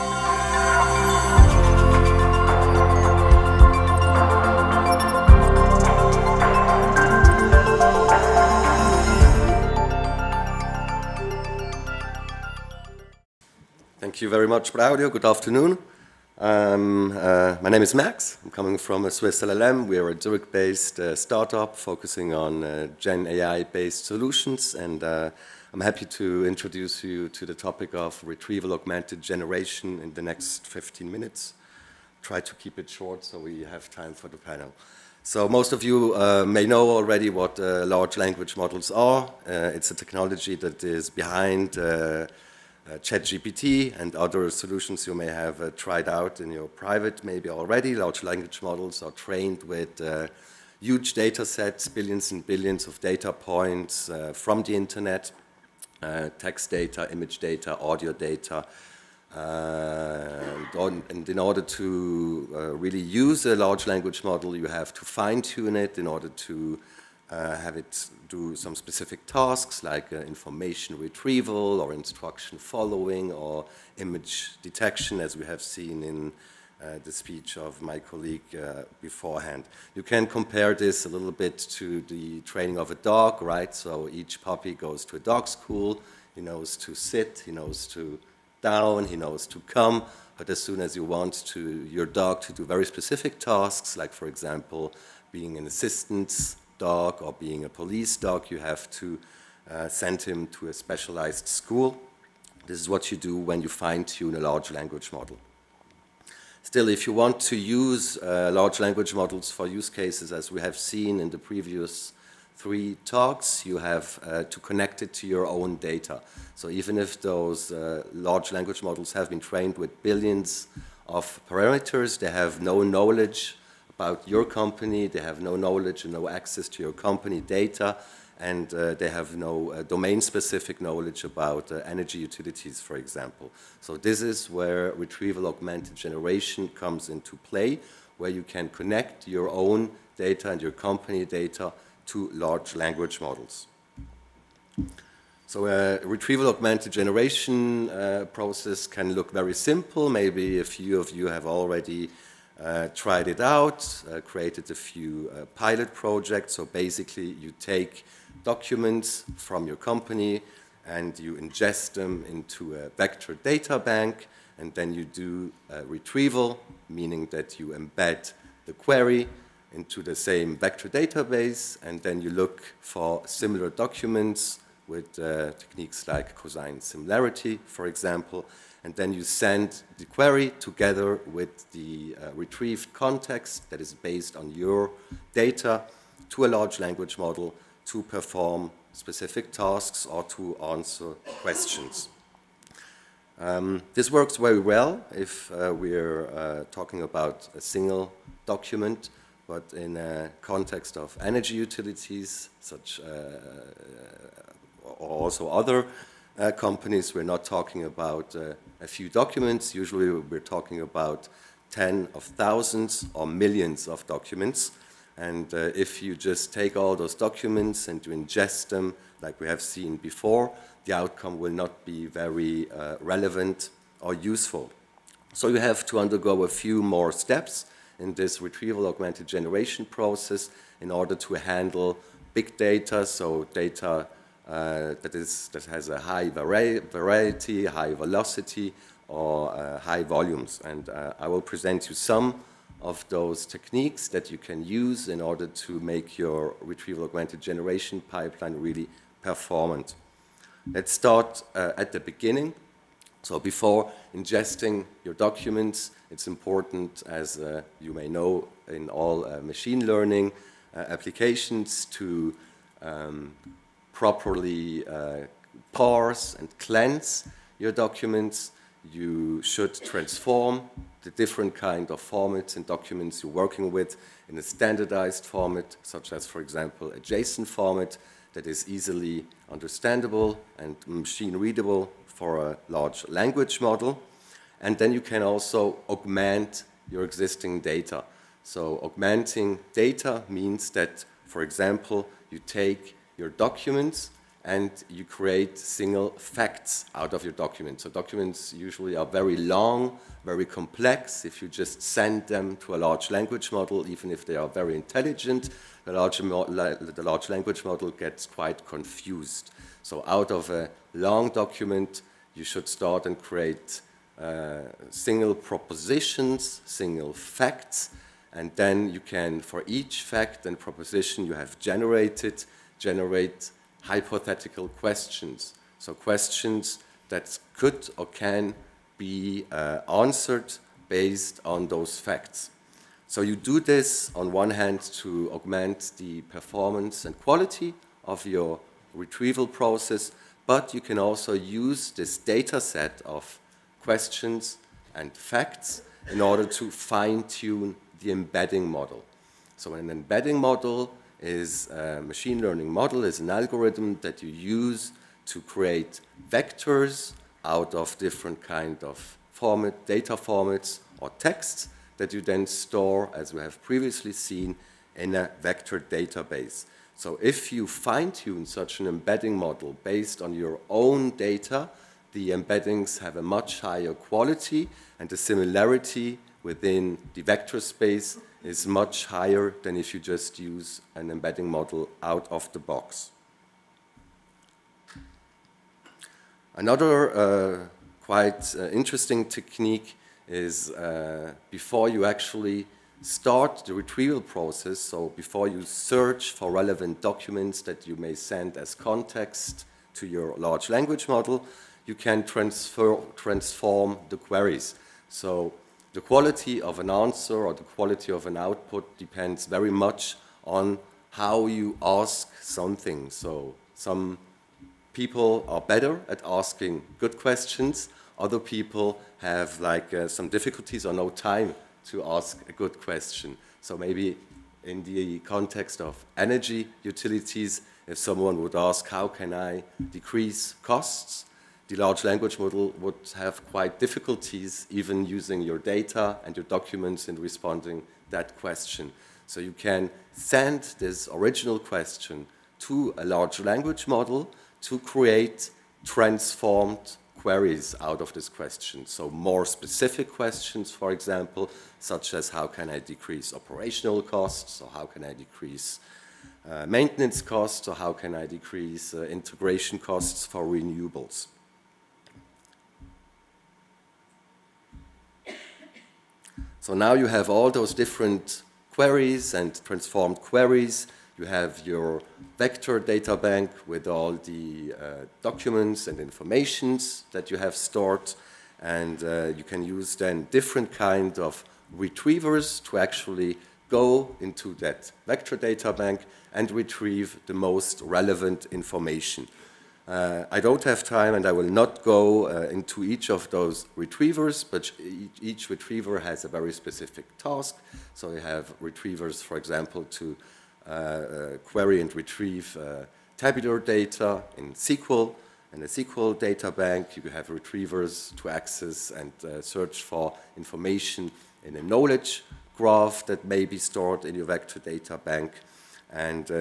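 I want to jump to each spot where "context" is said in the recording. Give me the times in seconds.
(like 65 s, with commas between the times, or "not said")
182 s, 200 s, 398 s, 425 s.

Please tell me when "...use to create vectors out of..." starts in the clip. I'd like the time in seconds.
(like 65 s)
354 s.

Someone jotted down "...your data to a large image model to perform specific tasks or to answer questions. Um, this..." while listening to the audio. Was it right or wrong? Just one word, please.
wrong.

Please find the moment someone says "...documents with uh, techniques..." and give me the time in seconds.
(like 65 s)
173 s.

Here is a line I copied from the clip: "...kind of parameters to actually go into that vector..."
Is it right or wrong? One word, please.
wrong.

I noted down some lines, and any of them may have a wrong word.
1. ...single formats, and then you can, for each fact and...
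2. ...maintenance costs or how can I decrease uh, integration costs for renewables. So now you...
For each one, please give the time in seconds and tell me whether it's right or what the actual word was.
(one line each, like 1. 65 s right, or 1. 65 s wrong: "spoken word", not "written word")
1. 316 s wrong: "facts", not "formats"
2. 456 s right.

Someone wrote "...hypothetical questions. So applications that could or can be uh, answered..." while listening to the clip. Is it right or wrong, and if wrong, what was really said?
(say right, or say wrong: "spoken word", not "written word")
wrong: "questions", not "applications".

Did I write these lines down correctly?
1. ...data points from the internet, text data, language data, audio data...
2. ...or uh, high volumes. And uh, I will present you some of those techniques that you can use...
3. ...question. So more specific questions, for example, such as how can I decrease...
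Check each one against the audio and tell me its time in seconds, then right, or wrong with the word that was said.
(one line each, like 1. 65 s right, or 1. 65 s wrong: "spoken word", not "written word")
1. 53 s wrong: "image", not "language"
2. 239 s right
3. 448 s right.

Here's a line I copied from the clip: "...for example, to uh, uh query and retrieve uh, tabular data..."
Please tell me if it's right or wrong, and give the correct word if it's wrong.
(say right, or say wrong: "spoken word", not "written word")
right.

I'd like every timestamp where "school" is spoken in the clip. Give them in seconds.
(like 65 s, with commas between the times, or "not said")
85 s, 101 s.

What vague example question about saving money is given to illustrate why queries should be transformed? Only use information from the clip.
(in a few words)
How can I decrease costs?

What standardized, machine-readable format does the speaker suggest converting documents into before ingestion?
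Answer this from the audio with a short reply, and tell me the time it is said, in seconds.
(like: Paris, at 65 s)
JSON, at 277 s.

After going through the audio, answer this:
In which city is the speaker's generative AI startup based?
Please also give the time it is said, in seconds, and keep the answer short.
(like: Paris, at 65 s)
Zurich, at 20 s.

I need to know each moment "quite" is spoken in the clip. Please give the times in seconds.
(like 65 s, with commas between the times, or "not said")
308 s, 388 s, 433 s.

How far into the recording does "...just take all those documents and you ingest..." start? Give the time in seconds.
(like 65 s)
216 s.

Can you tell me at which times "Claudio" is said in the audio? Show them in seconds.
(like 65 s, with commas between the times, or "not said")
14 s.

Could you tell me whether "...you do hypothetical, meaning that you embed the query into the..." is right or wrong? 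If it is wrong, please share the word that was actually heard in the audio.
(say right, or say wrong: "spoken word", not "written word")
wrong: "retrieval", not "hypothetical".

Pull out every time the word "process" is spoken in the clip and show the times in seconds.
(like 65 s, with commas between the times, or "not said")
148 s, 229 s, 339 s, 394 s.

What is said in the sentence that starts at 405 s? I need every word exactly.
So the quality of an answer or the quality of an output depends very much on how you ask something.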